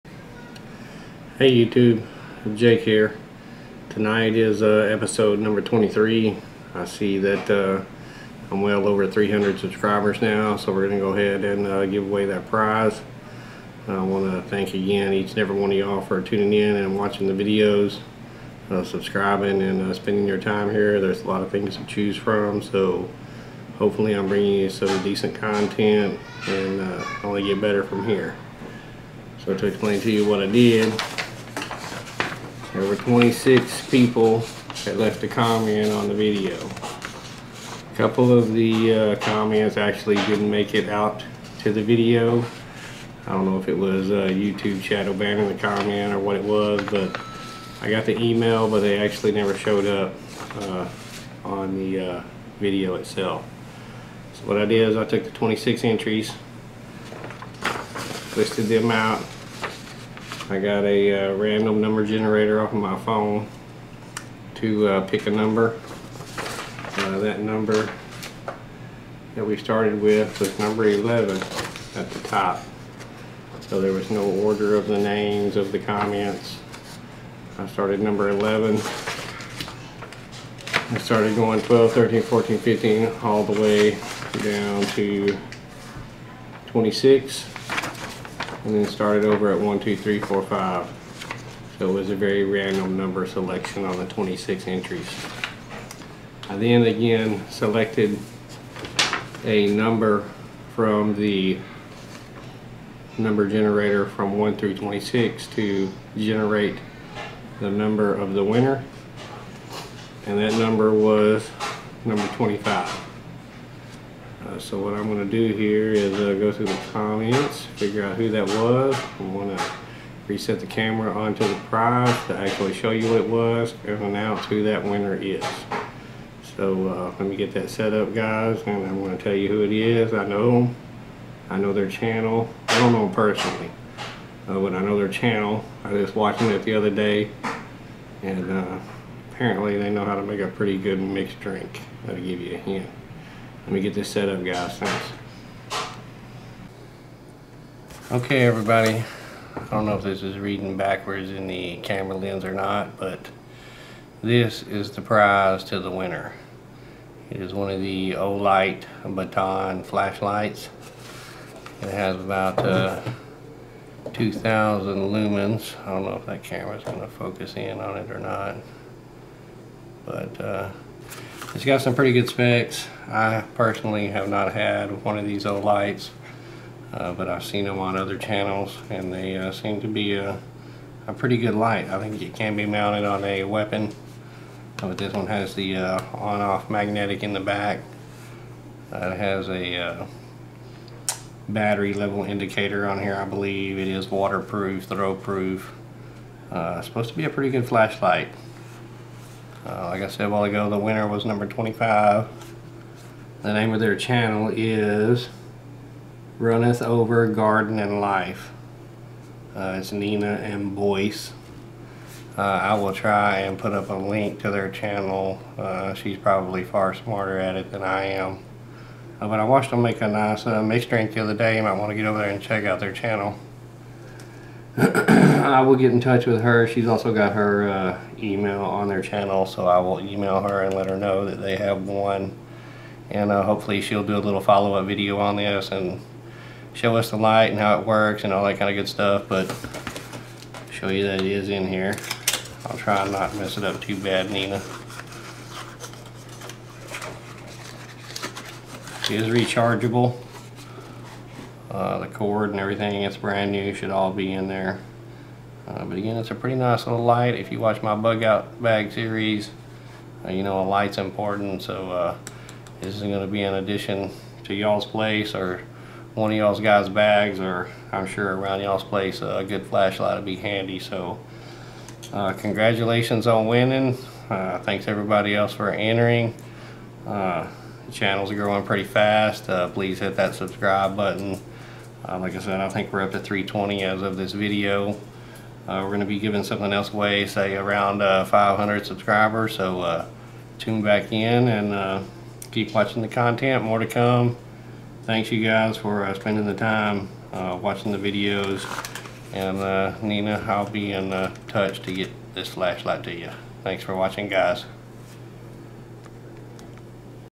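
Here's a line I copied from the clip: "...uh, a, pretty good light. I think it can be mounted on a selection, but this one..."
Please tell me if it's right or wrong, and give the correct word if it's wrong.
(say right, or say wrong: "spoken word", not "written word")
wrong: "weapon", not "selection".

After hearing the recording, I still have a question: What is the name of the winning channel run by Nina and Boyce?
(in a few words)
Runneth Over Garden and Life.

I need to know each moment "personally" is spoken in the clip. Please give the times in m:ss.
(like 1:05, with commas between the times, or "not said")
2:13, 2:53.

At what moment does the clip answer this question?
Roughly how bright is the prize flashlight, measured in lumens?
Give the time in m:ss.
2:44.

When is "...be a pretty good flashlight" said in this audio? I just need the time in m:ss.
3:17.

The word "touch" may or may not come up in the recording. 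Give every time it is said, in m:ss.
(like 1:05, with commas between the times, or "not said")
3:45, 5:01.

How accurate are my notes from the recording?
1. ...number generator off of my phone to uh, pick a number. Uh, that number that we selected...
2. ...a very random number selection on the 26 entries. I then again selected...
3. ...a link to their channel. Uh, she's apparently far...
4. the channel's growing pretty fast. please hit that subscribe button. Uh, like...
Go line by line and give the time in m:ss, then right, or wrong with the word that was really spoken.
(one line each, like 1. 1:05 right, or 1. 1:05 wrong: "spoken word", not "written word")
1. 1:01 wrong: "started", not "selected"
2. 1:32 right
3. 3:33 wrong: "probably", not "apparently"
4. 4:37 right.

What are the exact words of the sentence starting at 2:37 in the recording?
It is one of the Olight Baton flashlights.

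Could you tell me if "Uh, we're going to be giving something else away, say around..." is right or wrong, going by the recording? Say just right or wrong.
right.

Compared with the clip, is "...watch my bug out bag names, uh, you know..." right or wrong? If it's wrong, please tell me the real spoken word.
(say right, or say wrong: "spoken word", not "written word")
wrong: "series", not "names".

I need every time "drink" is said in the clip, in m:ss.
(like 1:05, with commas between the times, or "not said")
2:21, 3:40.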